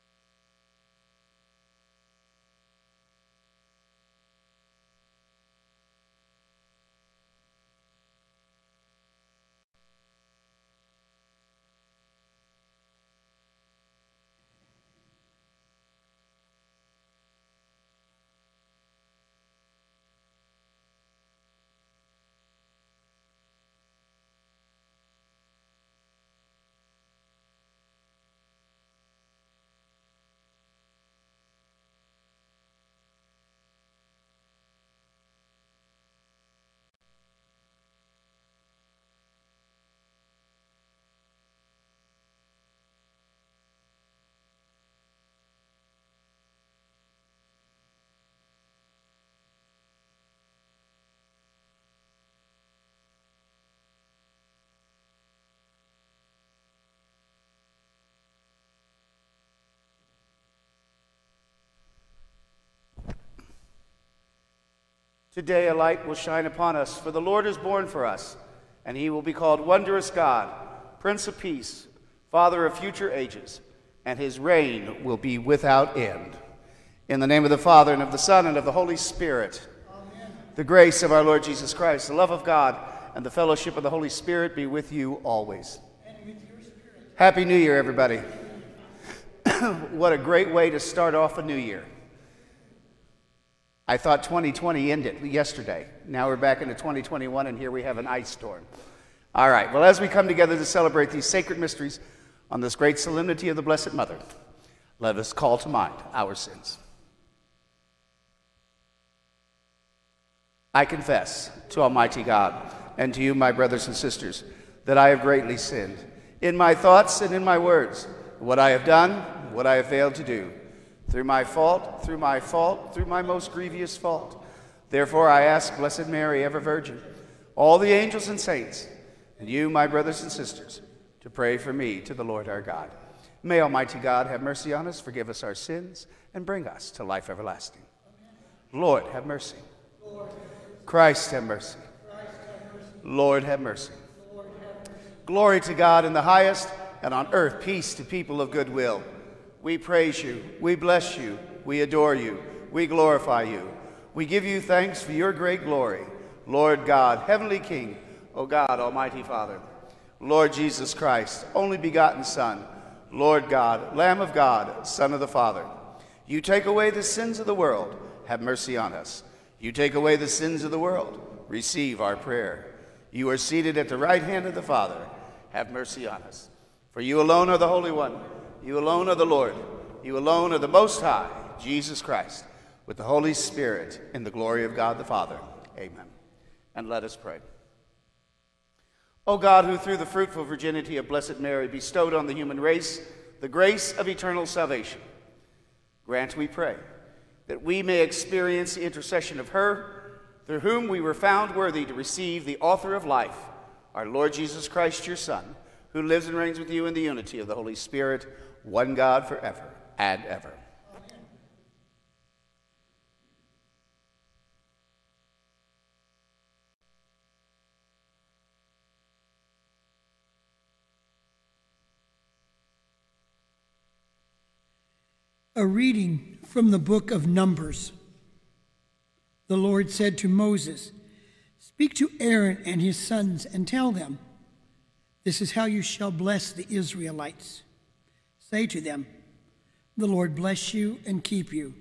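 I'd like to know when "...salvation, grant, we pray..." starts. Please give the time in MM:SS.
03:14.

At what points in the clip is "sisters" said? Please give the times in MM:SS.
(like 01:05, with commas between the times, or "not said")
01:53, 02:10.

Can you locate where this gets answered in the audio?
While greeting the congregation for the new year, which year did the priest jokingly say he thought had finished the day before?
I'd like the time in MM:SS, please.
01:34.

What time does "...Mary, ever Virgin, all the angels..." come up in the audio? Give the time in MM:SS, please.
02:06.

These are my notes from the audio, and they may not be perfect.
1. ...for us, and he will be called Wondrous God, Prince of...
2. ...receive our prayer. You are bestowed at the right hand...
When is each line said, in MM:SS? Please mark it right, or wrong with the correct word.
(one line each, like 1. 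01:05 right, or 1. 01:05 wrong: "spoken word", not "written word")
1. 01:07 right
2. 02:51 wrong: "seated", not "bestowed".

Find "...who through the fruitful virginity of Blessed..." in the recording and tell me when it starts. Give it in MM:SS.
03:09.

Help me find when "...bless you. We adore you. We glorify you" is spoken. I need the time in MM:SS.
02:30.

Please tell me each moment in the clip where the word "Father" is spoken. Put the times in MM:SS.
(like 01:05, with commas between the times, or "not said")
01:12, 01:17, 02:39, 02:45, 02:54, 03:05.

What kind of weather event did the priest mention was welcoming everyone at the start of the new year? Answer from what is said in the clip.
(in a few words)
ice storm.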